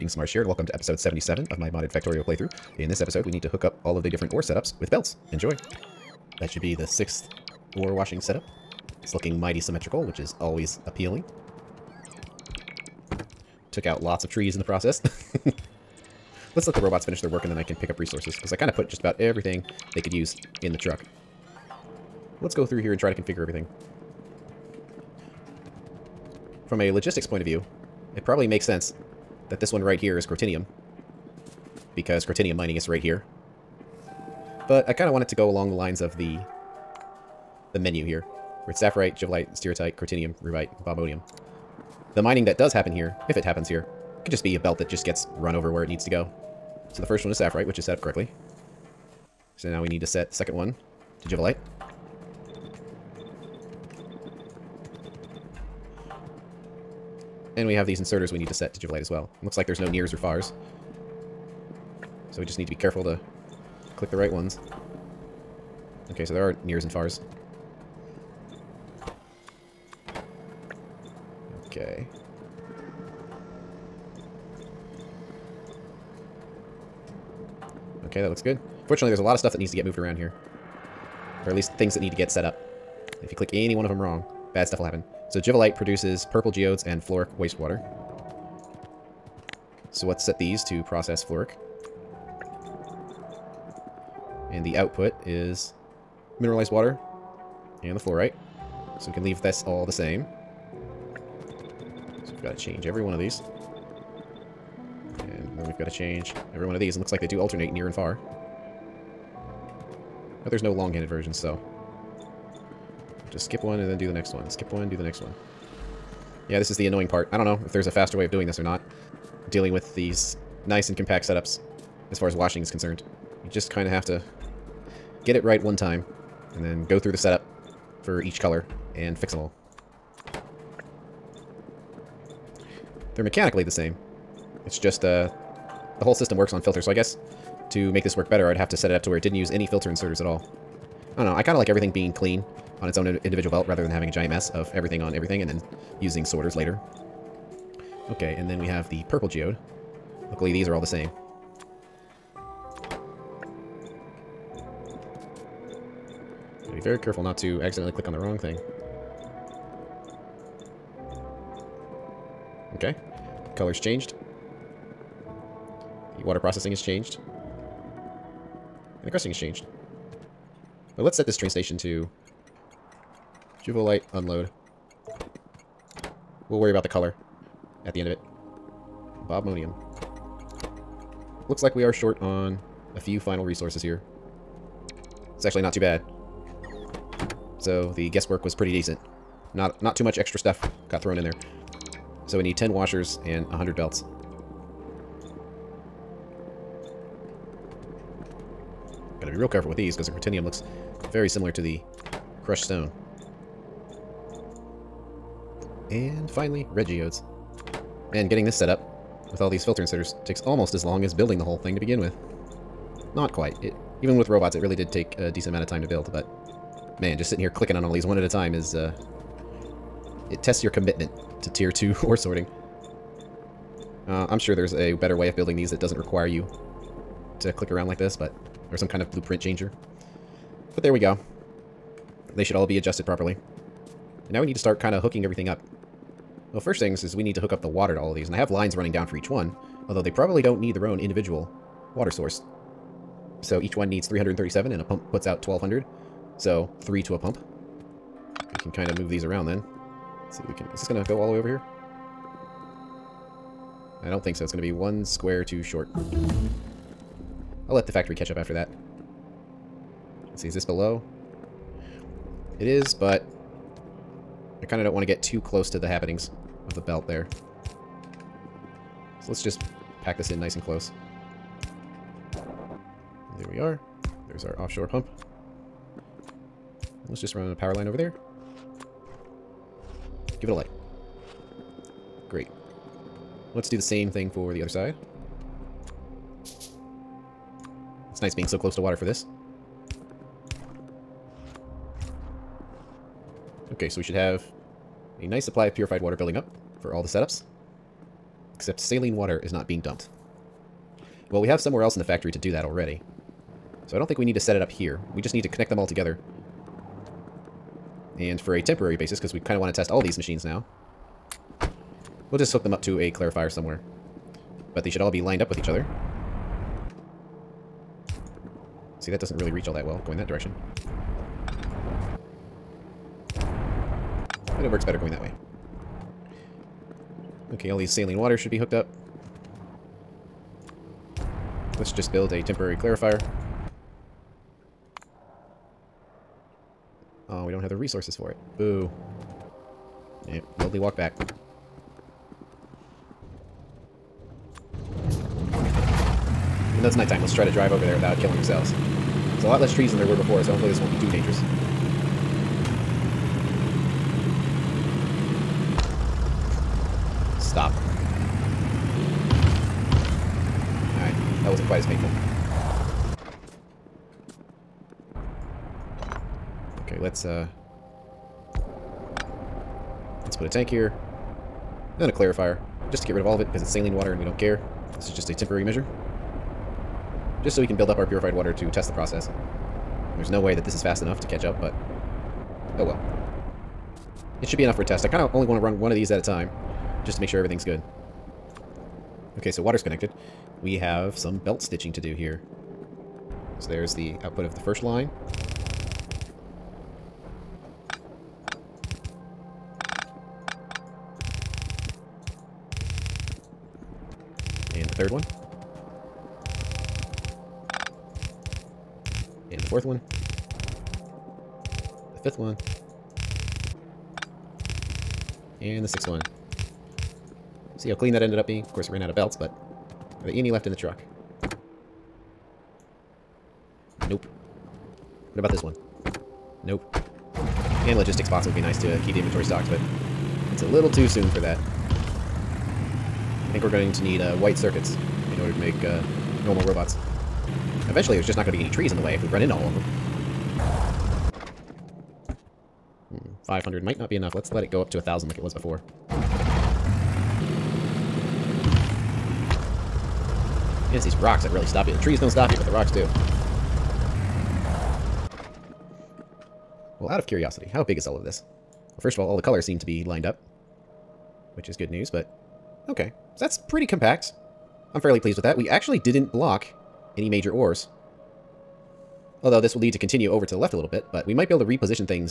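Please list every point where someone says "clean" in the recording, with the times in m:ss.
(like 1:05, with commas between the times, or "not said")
2:22, 6:57.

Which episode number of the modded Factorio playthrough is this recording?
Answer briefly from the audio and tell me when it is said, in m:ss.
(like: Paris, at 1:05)
77, at 0:00.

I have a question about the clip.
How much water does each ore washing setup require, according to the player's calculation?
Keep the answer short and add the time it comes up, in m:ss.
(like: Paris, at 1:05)
337, at 4:04.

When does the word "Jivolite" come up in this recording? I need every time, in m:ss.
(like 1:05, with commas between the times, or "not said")
0:58, 1:25, 2:53.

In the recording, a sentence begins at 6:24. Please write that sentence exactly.
It should be enough for a test.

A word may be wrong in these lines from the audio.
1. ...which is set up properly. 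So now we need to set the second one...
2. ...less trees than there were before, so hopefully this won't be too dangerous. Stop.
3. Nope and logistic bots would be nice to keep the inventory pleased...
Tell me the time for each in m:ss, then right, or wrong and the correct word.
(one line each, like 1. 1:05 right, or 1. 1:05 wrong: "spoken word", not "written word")
1. 0:47 wrong: "correctly", not "properly"
2. 5:49 right
3. 7:06 wrong: "stocked", not "pleased".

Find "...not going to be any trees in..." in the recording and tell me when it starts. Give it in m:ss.
7:18.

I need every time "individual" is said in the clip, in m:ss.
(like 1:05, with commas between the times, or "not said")
2:23, 4:00.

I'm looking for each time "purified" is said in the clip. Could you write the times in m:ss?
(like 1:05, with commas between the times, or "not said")
4:55, 6:18.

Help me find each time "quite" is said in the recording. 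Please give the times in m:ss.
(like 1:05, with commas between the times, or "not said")
3:33, 6:01.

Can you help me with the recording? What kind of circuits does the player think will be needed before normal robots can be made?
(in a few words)
White circuits.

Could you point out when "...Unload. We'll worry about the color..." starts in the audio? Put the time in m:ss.
2:54.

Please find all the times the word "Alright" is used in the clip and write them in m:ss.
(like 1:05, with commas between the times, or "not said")
6:00.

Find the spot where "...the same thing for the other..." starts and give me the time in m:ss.
4:43.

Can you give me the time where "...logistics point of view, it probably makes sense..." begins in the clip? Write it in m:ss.
0:26.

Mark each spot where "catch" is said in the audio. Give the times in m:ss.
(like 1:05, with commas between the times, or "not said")
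4:18, 6:21.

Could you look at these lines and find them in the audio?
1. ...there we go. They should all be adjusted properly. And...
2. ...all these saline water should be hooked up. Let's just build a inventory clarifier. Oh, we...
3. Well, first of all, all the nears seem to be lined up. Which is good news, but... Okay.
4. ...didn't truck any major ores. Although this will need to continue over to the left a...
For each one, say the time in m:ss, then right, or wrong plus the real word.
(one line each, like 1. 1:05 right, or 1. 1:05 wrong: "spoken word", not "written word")
1. 3:50 right
2. 5:27 wrong: "temporary", not "inventory"
3. 7:38 wrong: "colors", not "nears"
4. 7:45 wrong: "block", not "truck".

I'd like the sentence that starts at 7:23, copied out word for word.
Hmm, 500 might not be enough.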